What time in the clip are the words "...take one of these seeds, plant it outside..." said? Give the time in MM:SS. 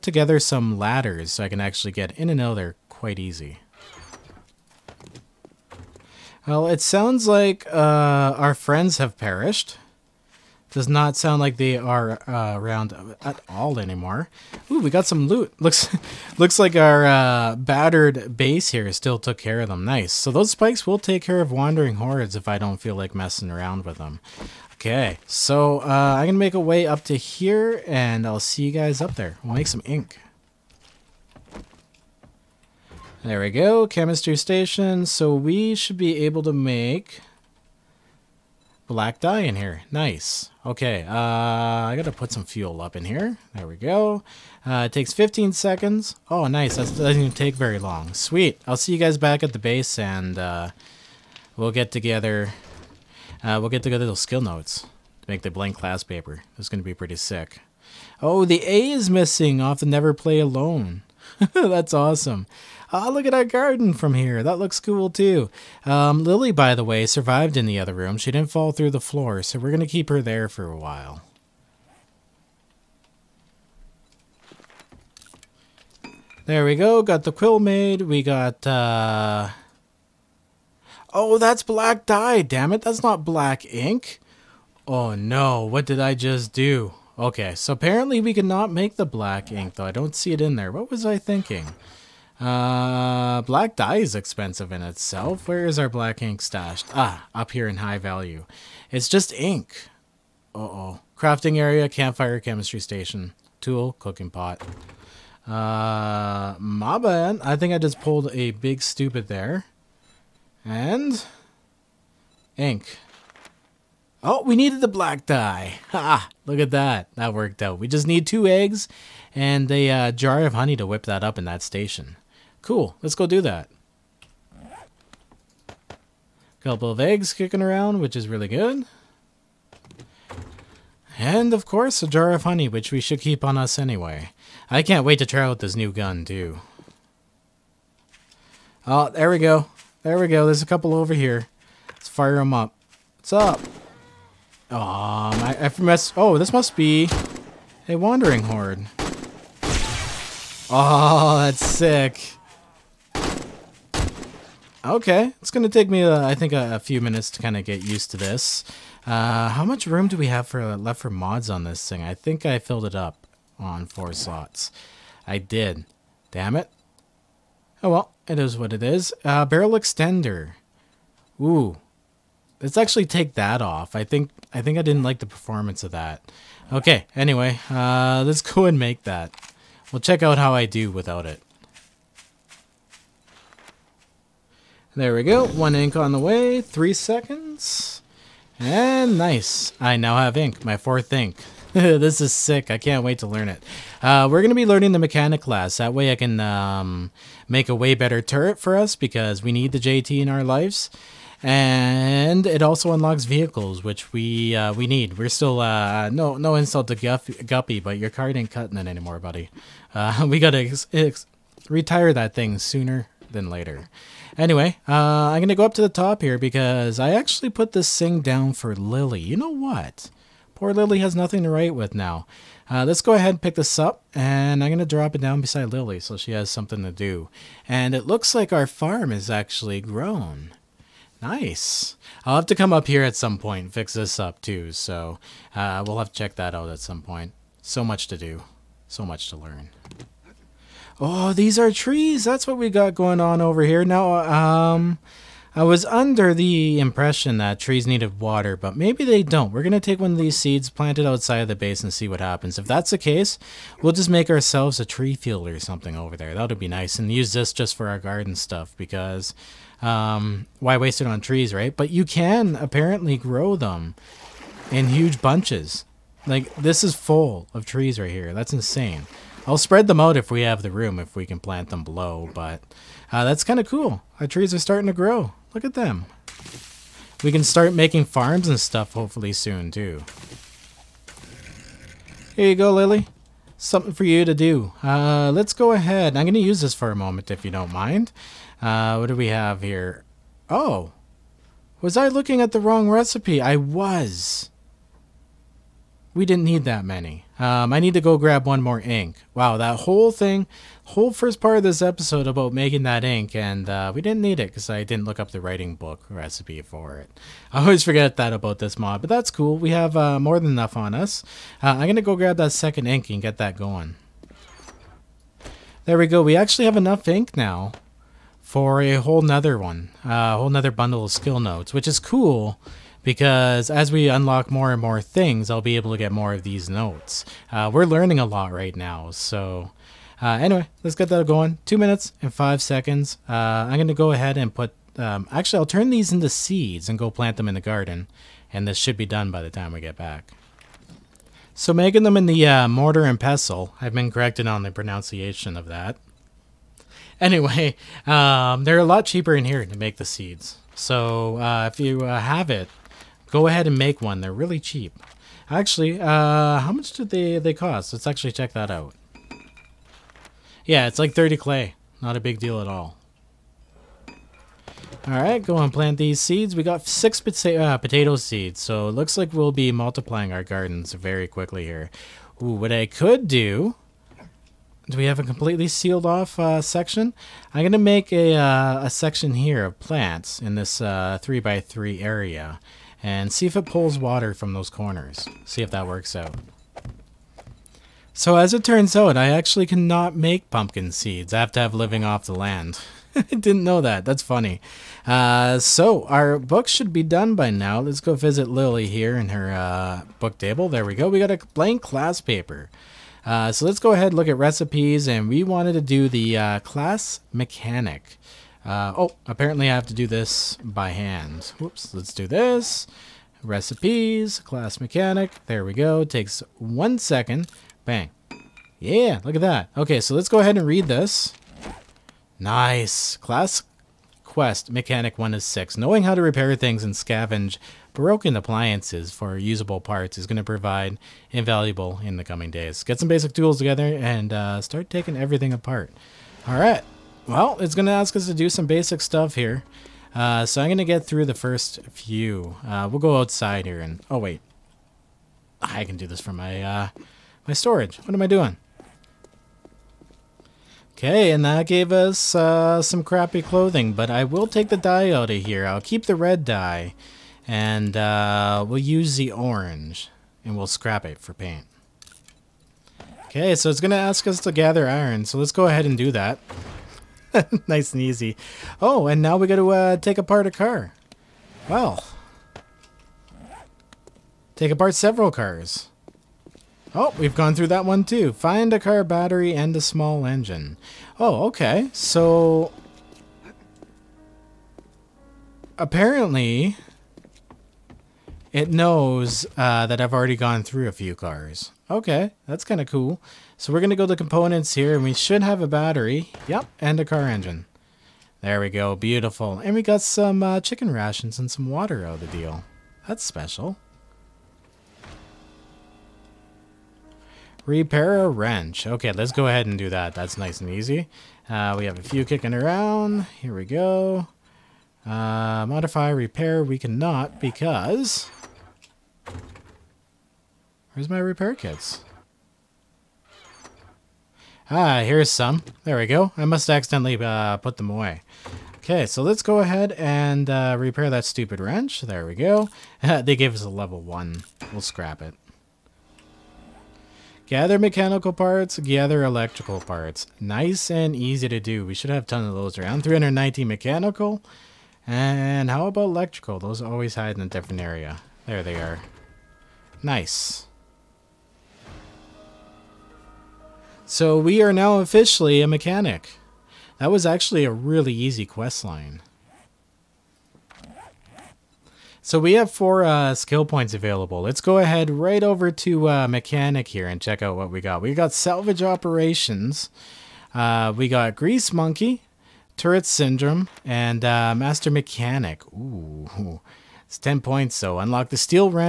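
04:09.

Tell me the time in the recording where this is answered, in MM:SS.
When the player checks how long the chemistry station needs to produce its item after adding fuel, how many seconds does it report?
00:45.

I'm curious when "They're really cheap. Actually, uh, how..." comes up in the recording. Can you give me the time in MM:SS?
05:54.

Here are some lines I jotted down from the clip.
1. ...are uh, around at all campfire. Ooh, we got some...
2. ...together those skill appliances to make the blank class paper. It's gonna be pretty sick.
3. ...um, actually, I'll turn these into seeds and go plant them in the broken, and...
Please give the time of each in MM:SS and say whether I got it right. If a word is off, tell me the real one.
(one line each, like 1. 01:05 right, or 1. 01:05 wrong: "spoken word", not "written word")
1. 00:11 wrong: "anymore", not "campfire"
2. 00:53 wrong: "notes", not "appliances"
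3. 05:34 wrong: "garden", not "broken".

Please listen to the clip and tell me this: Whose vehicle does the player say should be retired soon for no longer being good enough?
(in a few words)
Guff Guppy.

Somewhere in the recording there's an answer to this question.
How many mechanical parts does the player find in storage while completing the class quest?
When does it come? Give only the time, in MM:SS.
09:03.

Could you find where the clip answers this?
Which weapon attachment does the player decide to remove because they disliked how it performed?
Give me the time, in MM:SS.
02:49.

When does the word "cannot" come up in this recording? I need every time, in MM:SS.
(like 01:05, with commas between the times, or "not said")
01:28, 06:29, 08:36.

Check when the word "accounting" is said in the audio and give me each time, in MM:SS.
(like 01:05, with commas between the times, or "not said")
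not said.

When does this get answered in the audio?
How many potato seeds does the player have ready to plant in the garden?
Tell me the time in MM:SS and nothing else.
06:06.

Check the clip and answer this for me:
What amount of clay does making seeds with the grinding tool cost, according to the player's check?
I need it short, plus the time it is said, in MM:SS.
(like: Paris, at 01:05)
30, at 06:01.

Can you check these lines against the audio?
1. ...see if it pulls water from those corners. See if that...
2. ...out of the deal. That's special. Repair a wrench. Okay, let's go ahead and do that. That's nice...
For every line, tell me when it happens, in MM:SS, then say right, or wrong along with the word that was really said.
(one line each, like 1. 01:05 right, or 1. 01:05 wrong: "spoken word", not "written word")
1. 06:23 right
2. 08:22 right.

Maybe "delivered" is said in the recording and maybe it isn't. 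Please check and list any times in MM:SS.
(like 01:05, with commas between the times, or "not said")
not said.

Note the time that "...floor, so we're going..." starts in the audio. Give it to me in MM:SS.
01:08.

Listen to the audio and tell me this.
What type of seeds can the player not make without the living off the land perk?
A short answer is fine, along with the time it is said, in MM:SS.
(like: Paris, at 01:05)
pumpkin seeds, at 06:30.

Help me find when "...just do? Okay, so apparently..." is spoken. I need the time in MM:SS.
01:26.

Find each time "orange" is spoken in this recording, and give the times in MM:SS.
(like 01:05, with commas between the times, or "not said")
07:39.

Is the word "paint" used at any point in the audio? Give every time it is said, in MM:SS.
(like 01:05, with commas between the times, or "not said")
07:41.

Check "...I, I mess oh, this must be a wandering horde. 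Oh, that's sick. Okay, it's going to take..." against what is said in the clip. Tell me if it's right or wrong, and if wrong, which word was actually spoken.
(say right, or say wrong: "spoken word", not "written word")
right.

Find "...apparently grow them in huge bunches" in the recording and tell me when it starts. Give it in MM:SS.
04:22.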